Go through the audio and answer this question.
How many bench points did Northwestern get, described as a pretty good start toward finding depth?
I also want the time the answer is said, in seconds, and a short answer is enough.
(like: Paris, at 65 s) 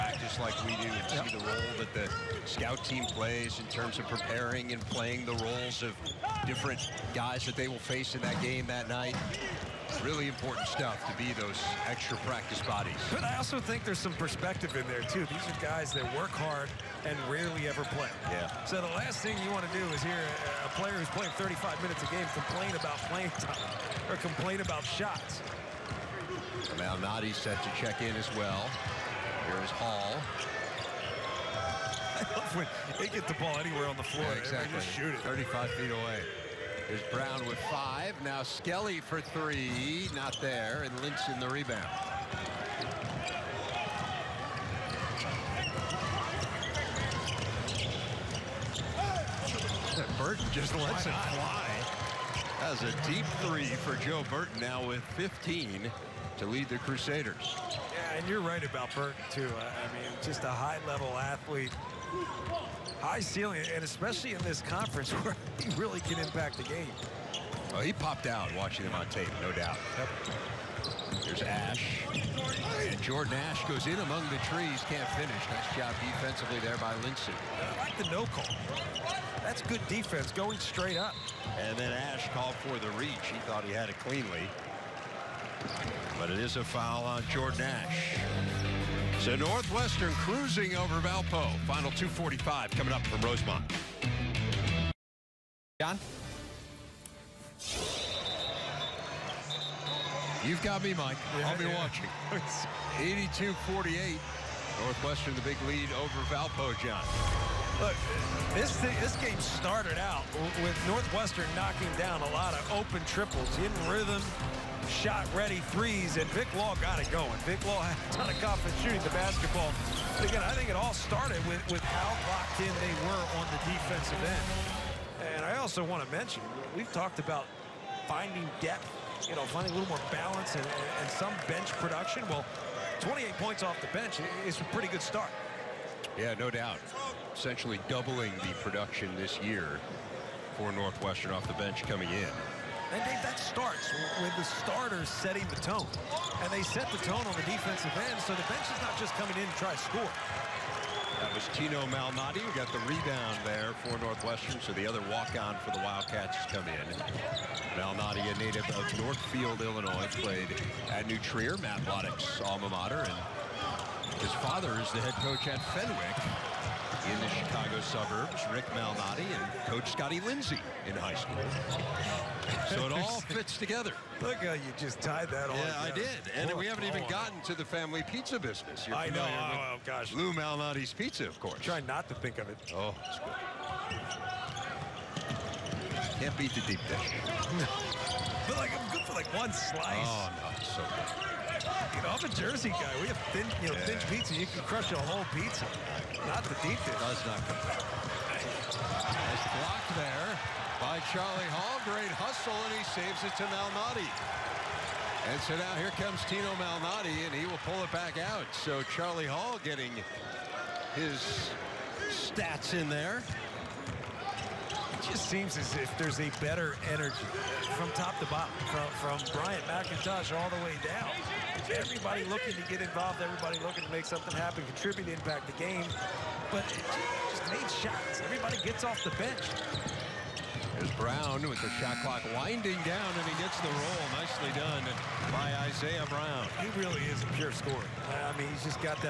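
28, at 132 s.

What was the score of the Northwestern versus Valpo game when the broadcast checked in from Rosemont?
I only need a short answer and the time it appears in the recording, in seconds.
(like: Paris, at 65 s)
82-48, at 103 s.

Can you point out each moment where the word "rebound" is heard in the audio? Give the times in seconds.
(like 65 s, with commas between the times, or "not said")
41 s, 152 s.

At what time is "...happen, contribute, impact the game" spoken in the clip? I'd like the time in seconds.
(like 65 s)
224 s.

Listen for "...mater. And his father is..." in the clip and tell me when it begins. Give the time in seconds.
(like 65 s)
162 s.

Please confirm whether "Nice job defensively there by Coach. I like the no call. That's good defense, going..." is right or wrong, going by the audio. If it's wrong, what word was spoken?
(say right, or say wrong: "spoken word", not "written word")
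wrong: "Linson", not "Coach".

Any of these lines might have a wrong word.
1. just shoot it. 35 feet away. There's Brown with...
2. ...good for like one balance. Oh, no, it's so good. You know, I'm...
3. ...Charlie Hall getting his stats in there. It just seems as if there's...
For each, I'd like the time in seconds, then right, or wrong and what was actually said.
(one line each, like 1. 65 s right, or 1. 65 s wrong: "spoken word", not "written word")
1. 34 s right
2. 188 s wrong: "slice", not "balance"
3. 208 s right.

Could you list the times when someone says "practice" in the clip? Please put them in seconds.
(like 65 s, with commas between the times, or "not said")
12 s.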